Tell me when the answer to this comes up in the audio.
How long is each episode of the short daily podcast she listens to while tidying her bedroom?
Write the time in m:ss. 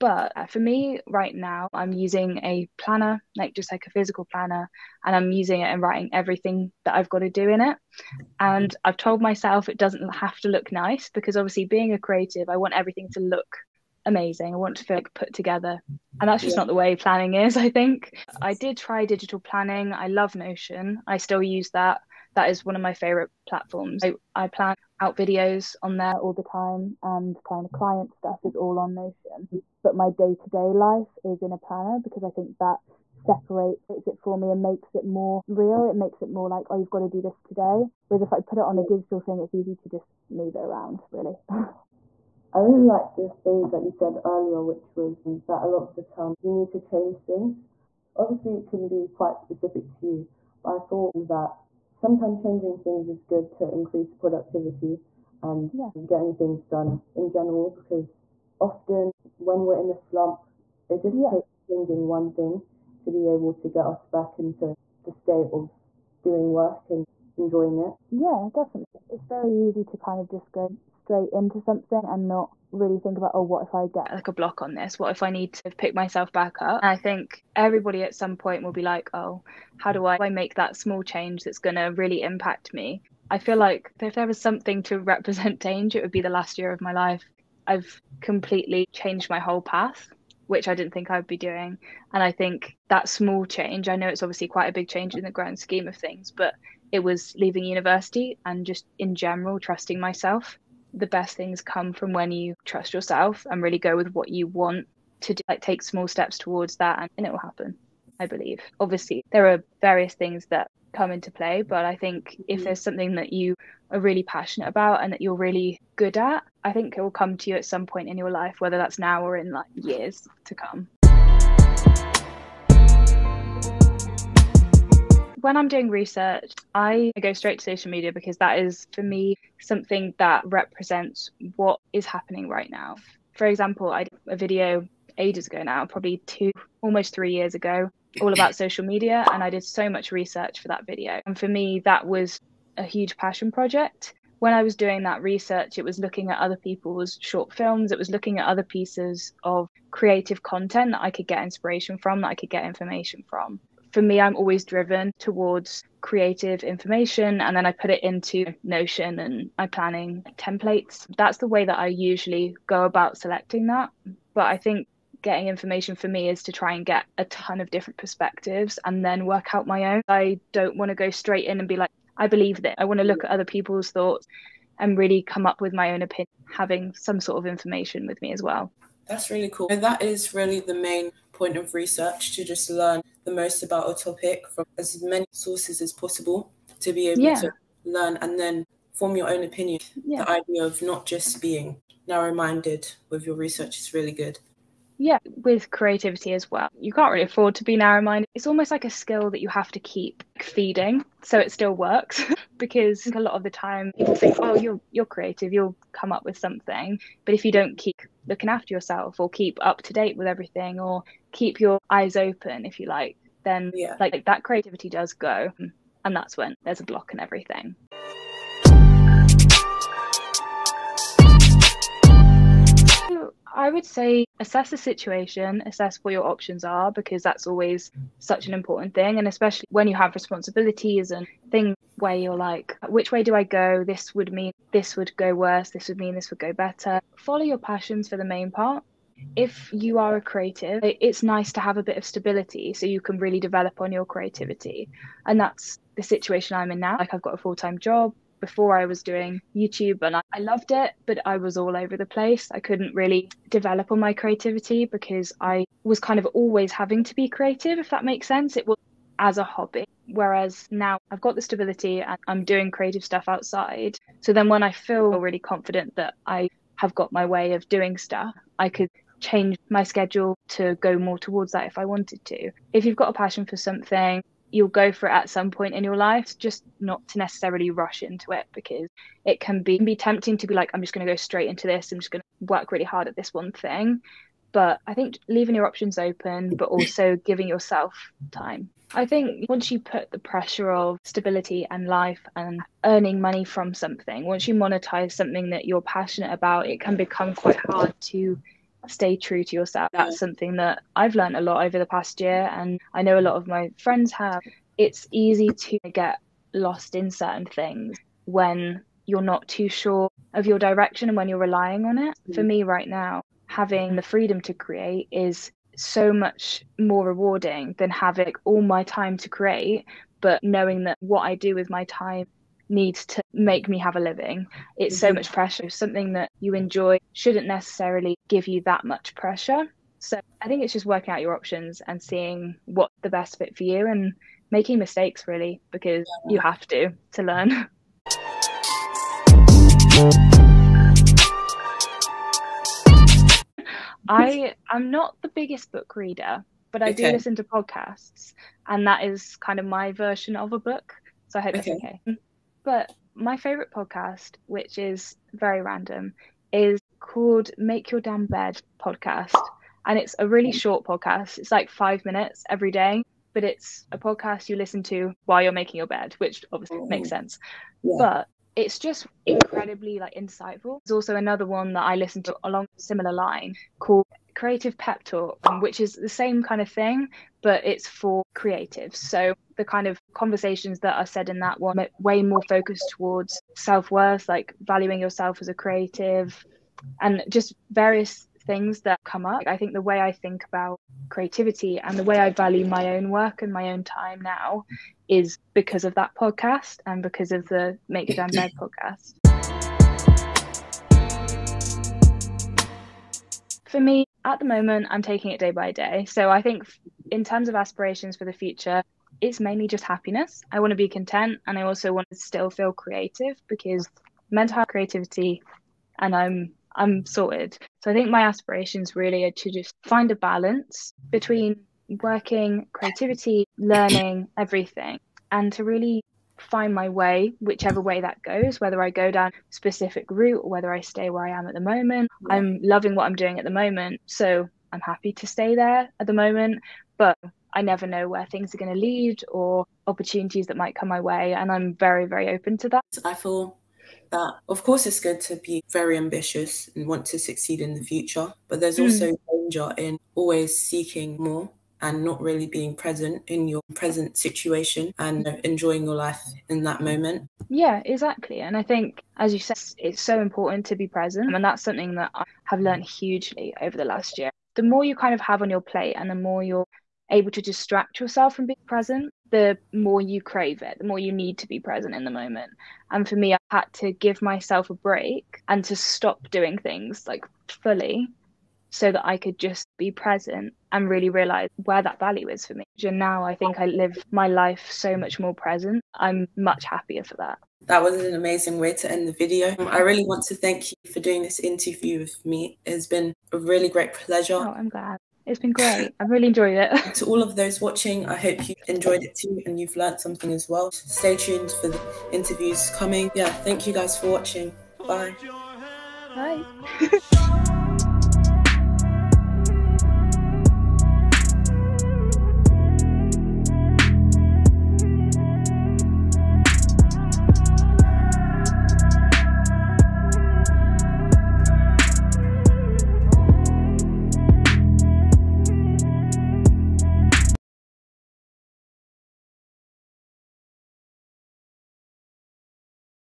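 6:01.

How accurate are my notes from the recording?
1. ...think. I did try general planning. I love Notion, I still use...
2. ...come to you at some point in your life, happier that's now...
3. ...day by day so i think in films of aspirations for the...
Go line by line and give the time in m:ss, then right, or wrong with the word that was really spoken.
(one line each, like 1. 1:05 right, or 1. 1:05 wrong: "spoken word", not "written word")
1. 0:17 wrong: "digital", not "general"
2. 1:57 wrong: "whether", not "happier"
3. 6:45 wrong: "terms", not "films".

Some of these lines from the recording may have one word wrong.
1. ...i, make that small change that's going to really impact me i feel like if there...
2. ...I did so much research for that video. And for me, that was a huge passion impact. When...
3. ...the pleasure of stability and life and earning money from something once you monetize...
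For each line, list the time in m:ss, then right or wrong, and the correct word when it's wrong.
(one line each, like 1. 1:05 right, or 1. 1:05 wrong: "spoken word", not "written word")
1. 1:20 right
2. 2:19 wrong: "project", not "impact"
3. 4:50 wrong: "pressure", not "pleasure".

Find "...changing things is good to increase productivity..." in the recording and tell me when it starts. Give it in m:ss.
0:52.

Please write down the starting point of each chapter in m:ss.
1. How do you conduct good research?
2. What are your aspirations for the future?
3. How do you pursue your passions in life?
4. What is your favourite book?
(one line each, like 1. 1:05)
1. 2:01
2. 7:40
3. 3:38
4. 5:38.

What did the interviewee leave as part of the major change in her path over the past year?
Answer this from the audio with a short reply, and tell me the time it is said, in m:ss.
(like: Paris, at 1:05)
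university, at 1:37.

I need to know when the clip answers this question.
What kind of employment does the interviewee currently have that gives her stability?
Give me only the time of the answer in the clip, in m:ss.
4:07.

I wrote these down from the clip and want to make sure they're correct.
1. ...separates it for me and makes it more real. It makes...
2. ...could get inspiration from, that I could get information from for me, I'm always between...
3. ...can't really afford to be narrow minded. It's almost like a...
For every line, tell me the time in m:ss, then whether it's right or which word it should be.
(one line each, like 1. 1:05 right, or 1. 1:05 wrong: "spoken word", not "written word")
1. 0:33 right
2. 2:31 wrong: "driven", not "between"
3. 3:16 right.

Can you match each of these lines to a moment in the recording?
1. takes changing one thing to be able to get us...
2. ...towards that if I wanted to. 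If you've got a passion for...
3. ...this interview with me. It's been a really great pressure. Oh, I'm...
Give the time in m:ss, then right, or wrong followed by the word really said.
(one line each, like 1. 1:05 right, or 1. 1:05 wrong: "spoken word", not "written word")
1. 1:01 right
2. 4:31 right
3. 8:11 wrong: "pleasure", not "pressure".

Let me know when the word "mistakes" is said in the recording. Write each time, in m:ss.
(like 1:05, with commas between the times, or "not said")
5:34.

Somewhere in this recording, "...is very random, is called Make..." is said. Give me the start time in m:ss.
5:54.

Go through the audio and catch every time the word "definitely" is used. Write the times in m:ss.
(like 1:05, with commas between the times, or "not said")
1:08.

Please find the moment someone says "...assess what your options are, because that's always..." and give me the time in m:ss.
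3:45.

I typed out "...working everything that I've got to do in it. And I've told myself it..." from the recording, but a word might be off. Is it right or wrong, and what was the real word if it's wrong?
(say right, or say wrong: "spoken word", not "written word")
wrong: "writing", not "working".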